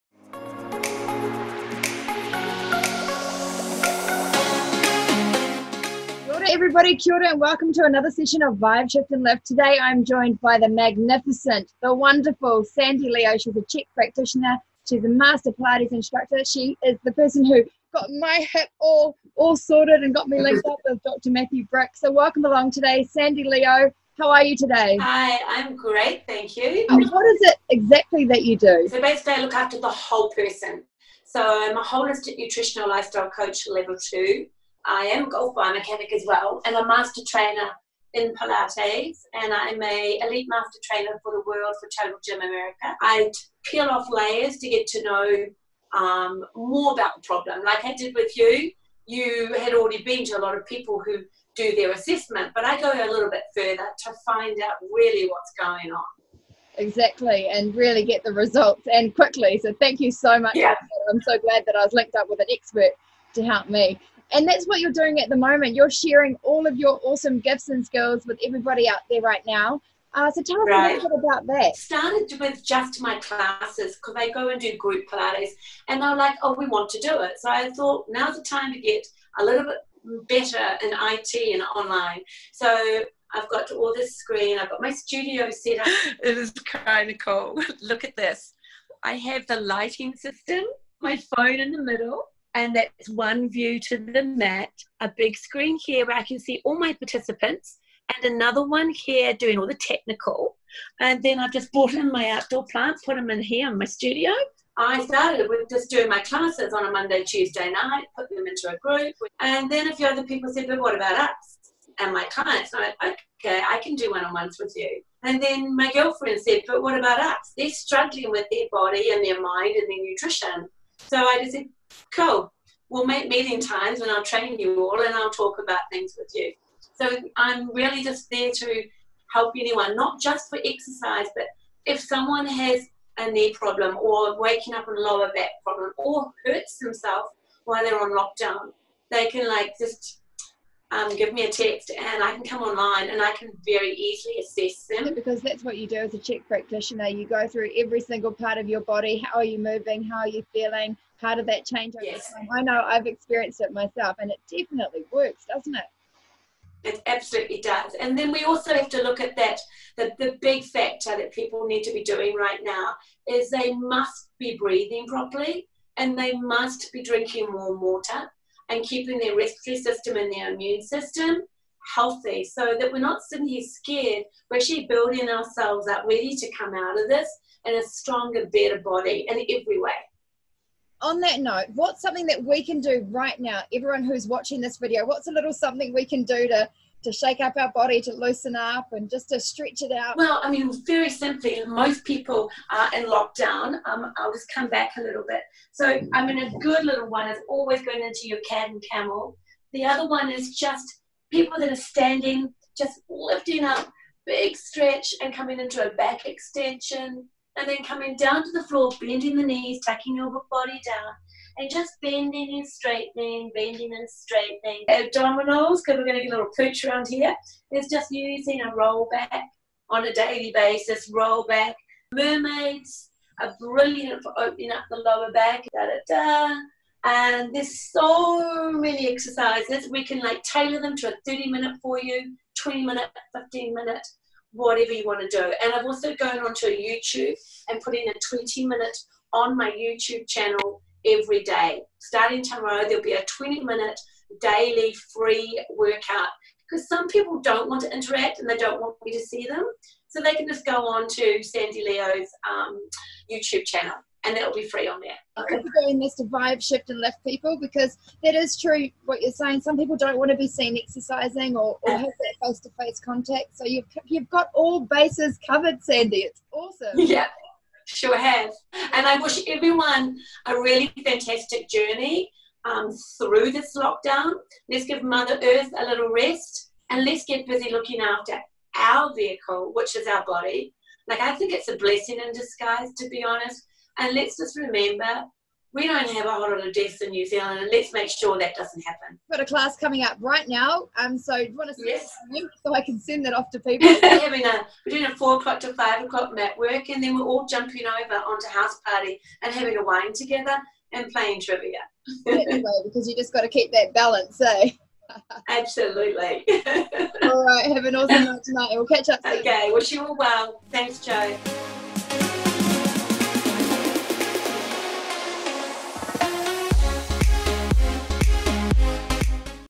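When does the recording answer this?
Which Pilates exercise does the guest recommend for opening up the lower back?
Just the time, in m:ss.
3:42.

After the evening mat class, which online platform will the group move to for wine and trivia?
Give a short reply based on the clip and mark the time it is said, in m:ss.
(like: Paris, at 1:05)
House Party, at 4:58.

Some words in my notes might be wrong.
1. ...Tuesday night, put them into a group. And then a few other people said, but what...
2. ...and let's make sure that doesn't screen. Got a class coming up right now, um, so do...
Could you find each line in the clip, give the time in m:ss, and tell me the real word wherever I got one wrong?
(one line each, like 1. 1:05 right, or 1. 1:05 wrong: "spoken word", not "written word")
1. 1:47 right
2. 4:47 wrong: "happen", not "screen".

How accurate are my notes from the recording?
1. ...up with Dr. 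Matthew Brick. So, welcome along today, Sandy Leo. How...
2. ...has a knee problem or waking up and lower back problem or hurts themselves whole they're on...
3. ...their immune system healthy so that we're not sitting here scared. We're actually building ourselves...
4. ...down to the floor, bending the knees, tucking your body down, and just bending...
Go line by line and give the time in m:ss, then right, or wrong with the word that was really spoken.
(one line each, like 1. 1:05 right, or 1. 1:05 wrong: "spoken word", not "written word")
1. 0:20 right
2. 2:12 wrong: "while", not "whole"
3. 2:50 right
4. 3:28 right.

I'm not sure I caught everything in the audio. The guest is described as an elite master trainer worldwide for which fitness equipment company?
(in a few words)
Total Gym America.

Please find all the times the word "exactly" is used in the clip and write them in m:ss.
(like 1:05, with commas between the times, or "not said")
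0:27, 0:56.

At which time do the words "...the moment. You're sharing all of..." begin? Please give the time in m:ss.
1:05.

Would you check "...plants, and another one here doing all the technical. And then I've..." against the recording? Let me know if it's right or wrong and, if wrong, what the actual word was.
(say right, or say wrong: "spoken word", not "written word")
wrong: "participants", not "plants".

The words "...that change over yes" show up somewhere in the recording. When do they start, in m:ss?
2:31.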